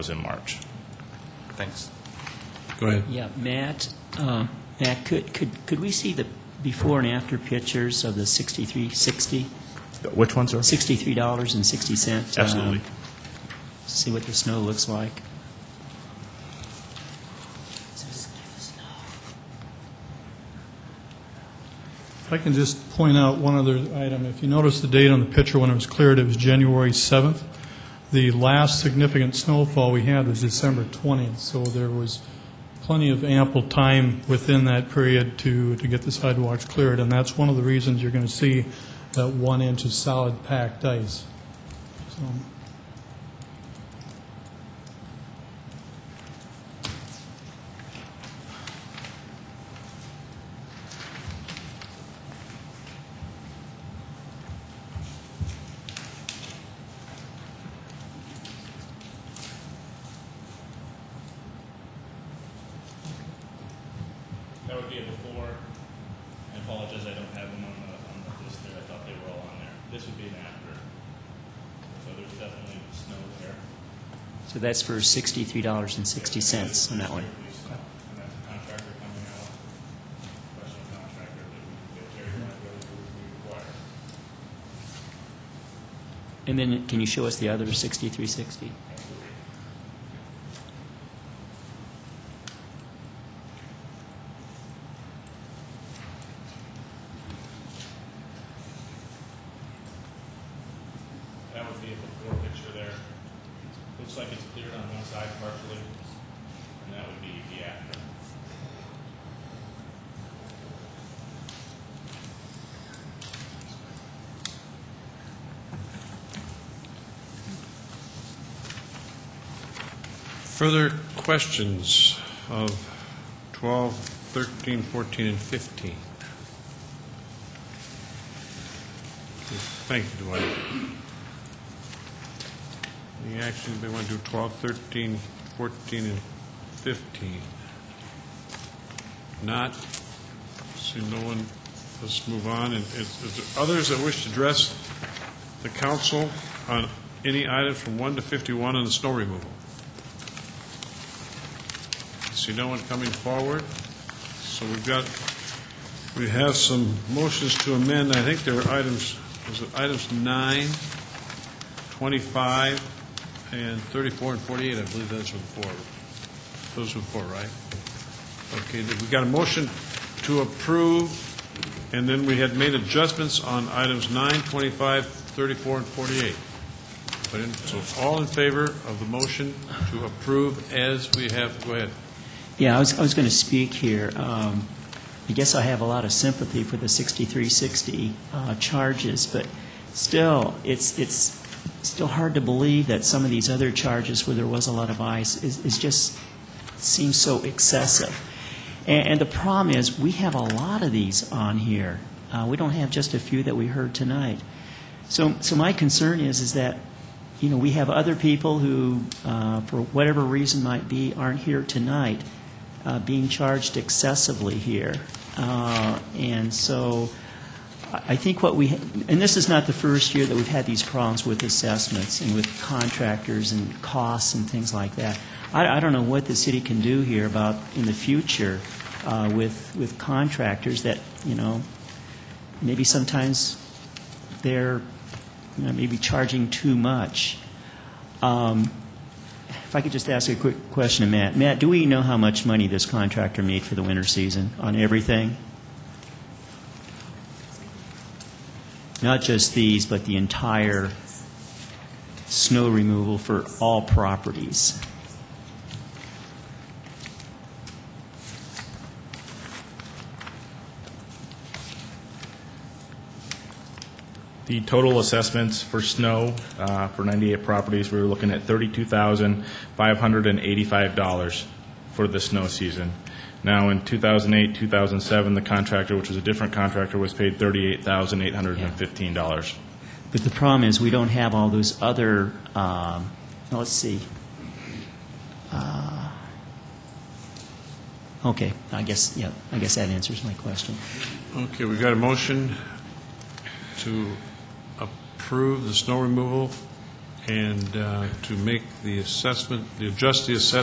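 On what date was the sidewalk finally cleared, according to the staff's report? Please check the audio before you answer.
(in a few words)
January 7.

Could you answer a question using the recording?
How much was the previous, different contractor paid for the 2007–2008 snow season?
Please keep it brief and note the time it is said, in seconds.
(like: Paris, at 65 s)
$38,815, at 277 s.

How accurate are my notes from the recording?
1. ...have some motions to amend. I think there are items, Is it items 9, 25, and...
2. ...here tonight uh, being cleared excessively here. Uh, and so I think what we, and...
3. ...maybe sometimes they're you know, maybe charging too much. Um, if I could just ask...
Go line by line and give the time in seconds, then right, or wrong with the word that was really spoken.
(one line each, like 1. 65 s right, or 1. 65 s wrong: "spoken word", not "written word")
1. 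156 s right
2. 211 s wrong: "charged", not "cleared"
3. 232 s right.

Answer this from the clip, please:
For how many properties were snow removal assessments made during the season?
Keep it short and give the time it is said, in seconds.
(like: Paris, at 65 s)
98, at 267 s.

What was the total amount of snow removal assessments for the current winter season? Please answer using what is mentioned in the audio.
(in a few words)
$32,585.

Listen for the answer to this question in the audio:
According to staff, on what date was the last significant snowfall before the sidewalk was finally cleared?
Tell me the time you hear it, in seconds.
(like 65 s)
30 s.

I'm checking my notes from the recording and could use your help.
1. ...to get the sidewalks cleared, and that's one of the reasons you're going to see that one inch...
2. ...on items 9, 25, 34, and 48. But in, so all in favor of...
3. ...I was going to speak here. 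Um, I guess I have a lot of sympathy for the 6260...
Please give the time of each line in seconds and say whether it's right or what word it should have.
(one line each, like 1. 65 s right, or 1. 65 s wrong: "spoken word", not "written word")
1. 35 s right
2. 173 s right
3. 182 s wrong: "6360", not "6260".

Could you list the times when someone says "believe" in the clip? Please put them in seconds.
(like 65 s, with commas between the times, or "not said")
164 s, 192 s.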